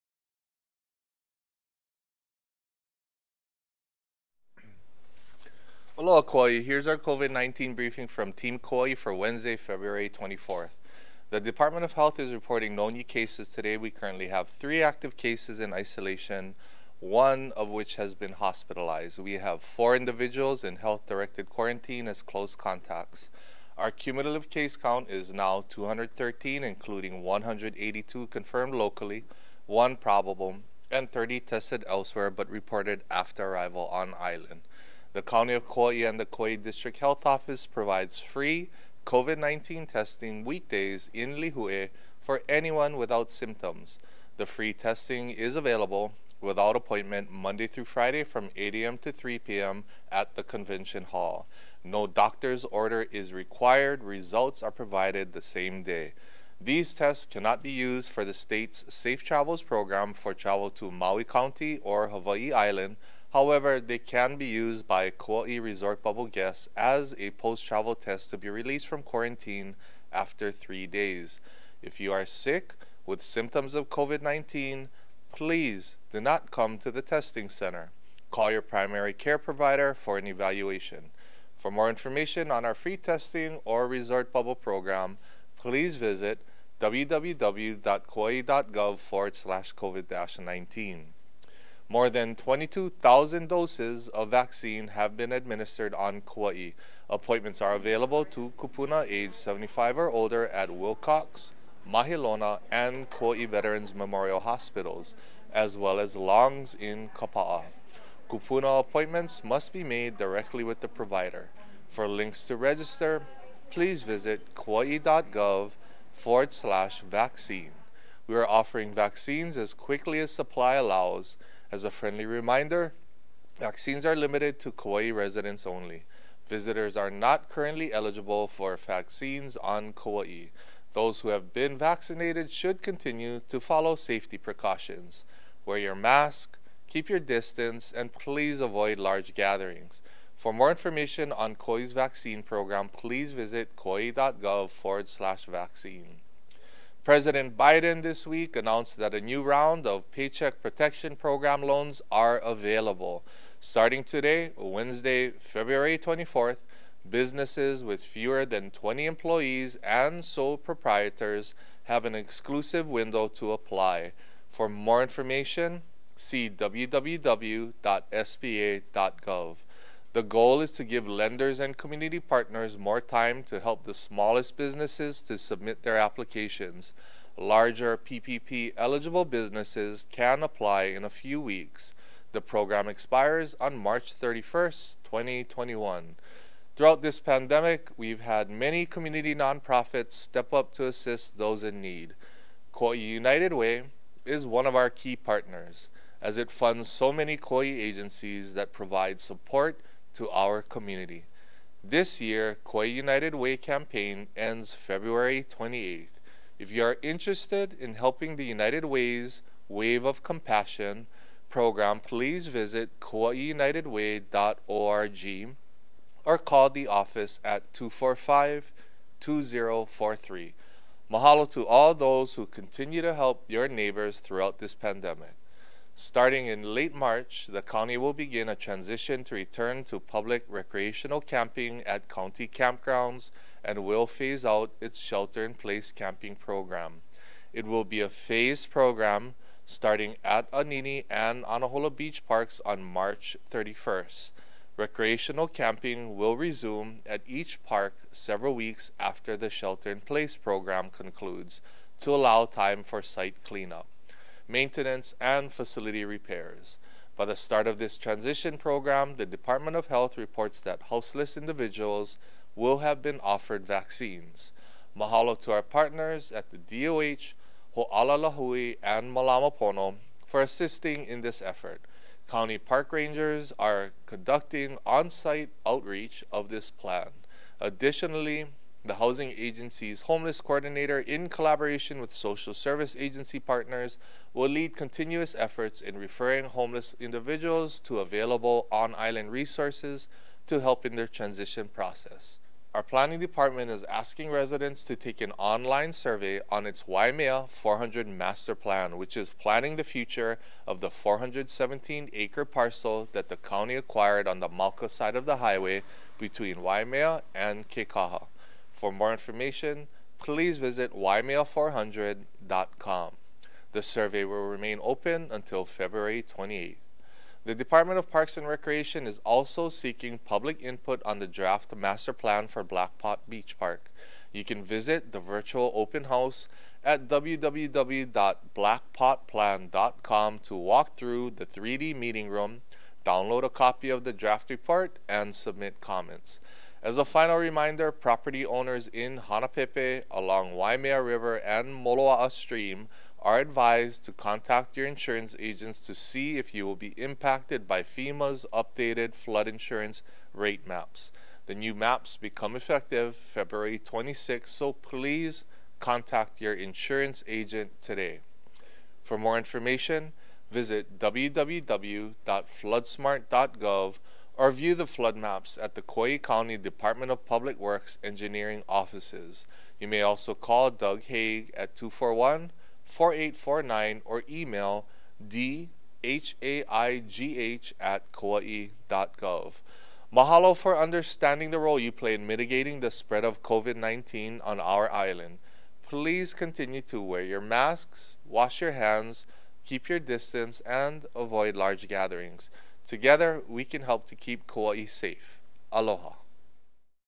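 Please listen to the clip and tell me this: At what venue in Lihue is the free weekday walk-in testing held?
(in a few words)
convention hall.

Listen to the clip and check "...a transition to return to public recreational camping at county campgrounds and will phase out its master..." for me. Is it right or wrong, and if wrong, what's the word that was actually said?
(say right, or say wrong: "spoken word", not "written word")
wrong: "shelter", not "master".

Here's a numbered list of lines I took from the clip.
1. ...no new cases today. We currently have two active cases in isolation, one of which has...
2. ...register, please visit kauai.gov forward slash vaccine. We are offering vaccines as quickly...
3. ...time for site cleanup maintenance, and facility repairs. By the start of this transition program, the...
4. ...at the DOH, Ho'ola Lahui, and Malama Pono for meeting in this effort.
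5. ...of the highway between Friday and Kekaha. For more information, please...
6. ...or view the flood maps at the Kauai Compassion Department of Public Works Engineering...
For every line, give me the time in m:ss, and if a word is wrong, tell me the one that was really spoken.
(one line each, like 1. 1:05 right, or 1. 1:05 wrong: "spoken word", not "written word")
1. 0:12 wrong: "three", not "two"
2. 1:52 right
3. 4:12 right
4. 4:26 wrong: "assisting", not "meeting"
5. 5:05 wrong: "Waimea", not "Friday"
6. 6:04 wrong: "County", not "Compassion".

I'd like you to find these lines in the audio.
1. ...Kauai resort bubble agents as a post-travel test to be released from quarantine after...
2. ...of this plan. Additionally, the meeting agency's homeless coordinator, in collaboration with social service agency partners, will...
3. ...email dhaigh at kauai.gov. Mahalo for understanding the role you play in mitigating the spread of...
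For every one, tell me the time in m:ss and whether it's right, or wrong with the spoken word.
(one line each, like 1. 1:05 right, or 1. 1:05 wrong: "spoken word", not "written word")
1. 1:05 wrong: "guests", not "agents"
2. 4:36 wrong: "housing", not "meeting"
3. 6:14 right.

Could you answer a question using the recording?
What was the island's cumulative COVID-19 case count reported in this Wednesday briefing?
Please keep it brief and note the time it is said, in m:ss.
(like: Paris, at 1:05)
213, at 0:25.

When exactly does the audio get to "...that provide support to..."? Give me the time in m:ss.
3:18.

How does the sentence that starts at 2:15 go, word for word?
Wear your mask, keep your distance, and please avoid large gatherings.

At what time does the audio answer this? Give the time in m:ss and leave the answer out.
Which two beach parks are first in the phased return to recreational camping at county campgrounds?
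4:00.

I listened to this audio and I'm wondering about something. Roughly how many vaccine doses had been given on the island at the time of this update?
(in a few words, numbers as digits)
more than 22,000.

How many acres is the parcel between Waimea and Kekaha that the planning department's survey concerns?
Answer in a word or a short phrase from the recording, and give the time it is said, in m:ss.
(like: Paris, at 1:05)
417, at 5:00.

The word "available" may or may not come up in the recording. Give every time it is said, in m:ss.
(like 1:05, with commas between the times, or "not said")
0:45, 1:37, 2:32, 4:47.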